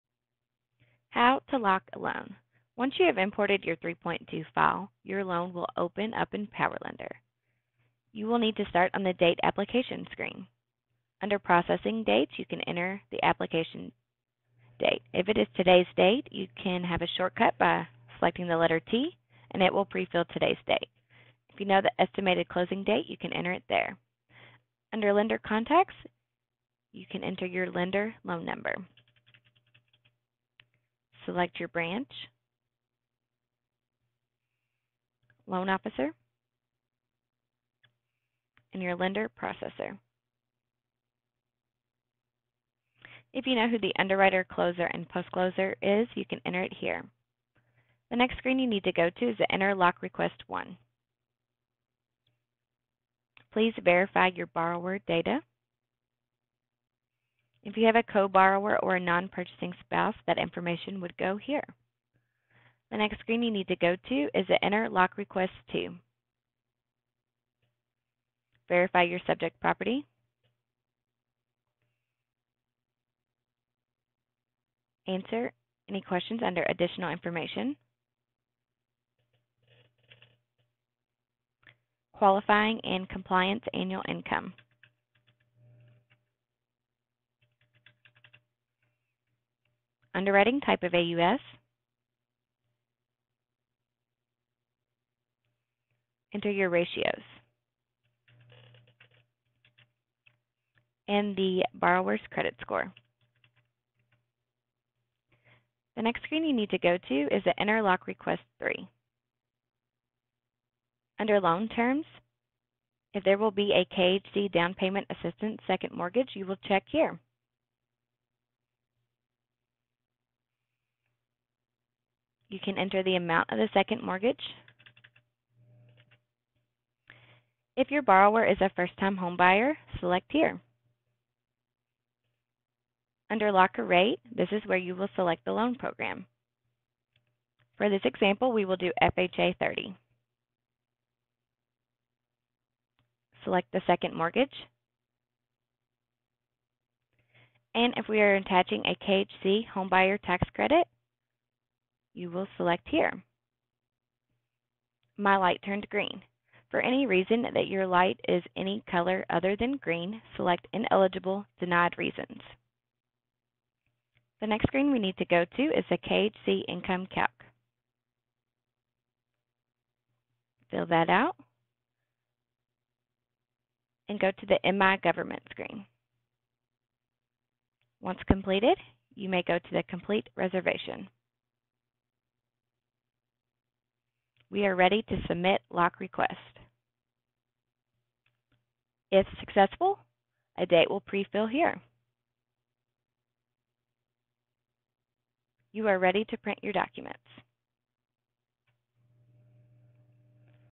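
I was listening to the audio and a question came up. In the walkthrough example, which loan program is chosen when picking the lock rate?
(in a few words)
FHA 30.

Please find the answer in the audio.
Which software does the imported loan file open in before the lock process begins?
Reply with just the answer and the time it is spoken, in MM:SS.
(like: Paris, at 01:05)
PowerLender, at 00:06.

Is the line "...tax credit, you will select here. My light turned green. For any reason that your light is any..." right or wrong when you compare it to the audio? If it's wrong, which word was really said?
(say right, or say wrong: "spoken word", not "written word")
right.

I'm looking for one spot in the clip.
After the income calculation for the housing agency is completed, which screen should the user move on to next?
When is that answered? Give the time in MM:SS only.
02:54.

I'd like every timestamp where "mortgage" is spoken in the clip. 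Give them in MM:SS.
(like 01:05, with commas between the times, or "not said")
01:55, 02:04, 02:24.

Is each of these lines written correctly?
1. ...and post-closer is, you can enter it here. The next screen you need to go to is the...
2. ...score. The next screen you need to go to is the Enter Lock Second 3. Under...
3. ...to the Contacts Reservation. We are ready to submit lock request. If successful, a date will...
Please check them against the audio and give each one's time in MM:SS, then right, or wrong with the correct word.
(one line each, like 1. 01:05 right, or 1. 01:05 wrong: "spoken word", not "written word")
1. 00:44 right
2. 01:42 wrong: "Request", not "Second"
3. 02:59 wrong: "Complete", not "Contacts".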